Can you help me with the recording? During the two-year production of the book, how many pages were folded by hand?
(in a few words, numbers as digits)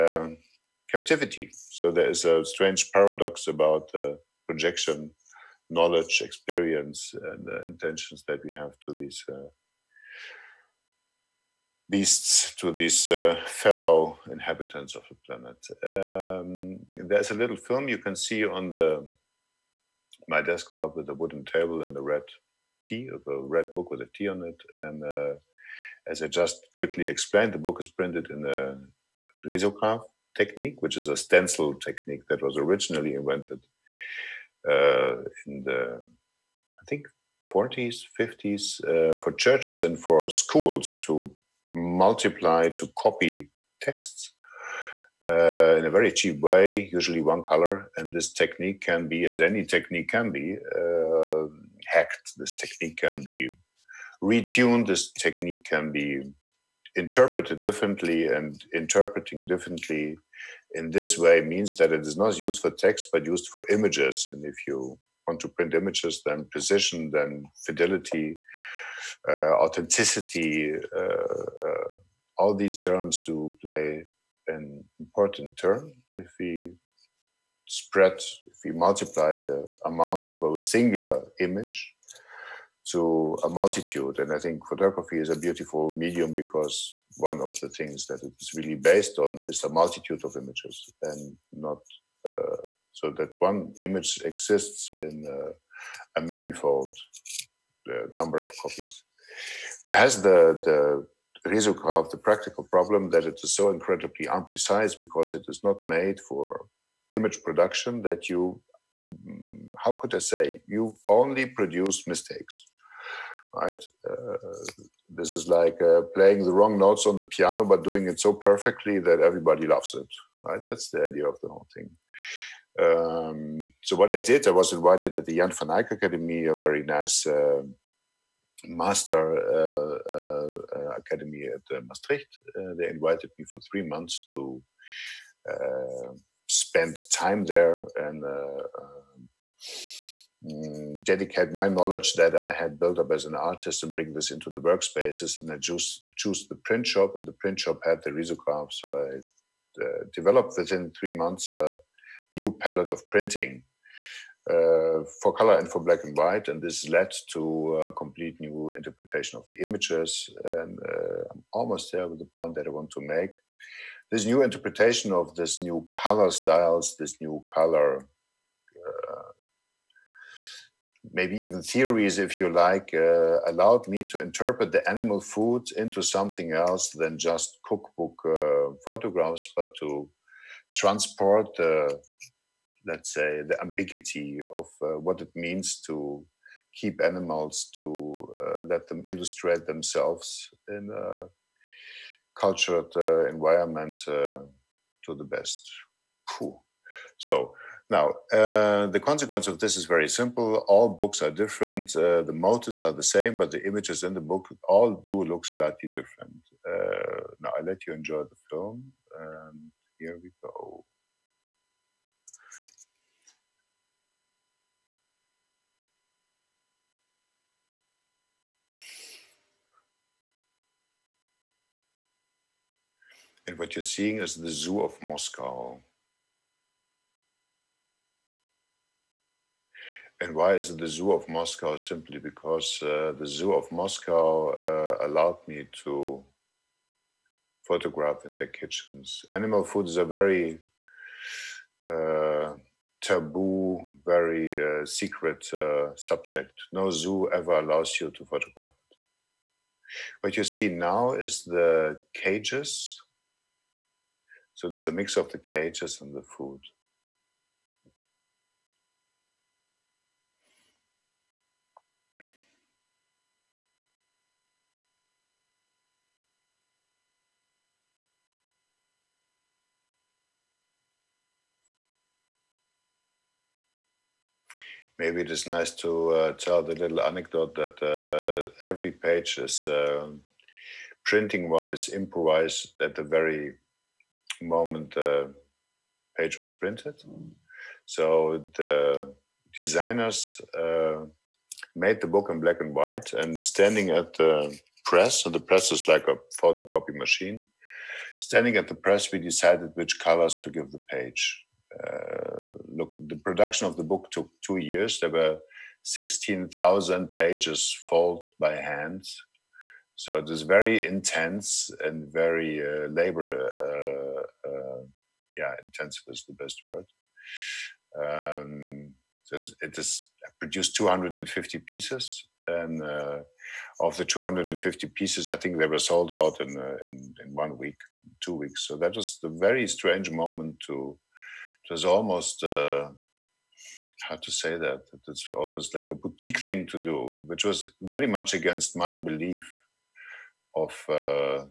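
16,000.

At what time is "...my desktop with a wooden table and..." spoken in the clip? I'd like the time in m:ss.
0:20.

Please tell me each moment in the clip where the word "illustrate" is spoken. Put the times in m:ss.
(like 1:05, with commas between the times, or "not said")
3:09.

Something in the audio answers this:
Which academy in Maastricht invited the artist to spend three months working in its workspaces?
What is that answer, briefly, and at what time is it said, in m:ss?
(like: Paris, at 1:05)
Jan van Eyck Academy, at 2:05.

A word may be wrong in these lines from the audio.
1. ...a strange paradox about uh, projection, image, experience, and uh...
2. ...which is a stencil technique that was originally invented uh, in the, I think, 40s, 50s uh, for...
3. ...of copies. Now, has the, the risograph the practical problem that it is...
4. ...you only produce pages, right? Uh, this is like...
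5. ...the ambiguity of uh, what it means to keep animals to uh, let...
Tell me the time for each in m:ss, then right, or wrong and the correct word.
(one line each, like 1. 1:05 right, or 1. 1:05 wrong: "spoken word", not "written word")
1. 0:02 wrong: "knowledge", not "image"
2. 0:30 right
3. 1:38 right
4. 1:50 wrong: "mistakes", not "pages"
5. 3:03 right.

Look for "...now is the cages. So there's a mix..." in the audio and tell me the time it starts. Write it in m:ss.
4:10.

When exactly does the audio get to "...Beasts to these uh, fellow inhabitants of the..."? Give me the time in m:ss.
0:11.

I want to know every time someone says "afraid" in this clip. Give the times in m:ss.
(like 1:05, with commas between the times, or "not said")
not said.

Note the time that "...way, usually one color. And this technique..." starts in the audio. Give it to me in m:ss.
0:46.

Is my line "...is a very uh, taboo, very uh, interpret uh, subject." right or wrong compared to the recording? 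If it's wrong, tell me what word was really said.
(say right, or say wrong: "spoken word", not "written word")
wrong: "secret", not "interpret".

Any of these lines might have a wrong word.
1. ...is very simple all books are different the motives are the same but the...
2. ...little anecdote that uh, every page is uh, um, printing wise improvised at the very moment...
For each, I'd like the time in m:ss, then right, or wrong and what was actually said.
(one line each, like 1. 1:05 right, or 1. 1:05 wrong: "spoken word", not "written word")
1. 3:19 right
2. 4:36 right.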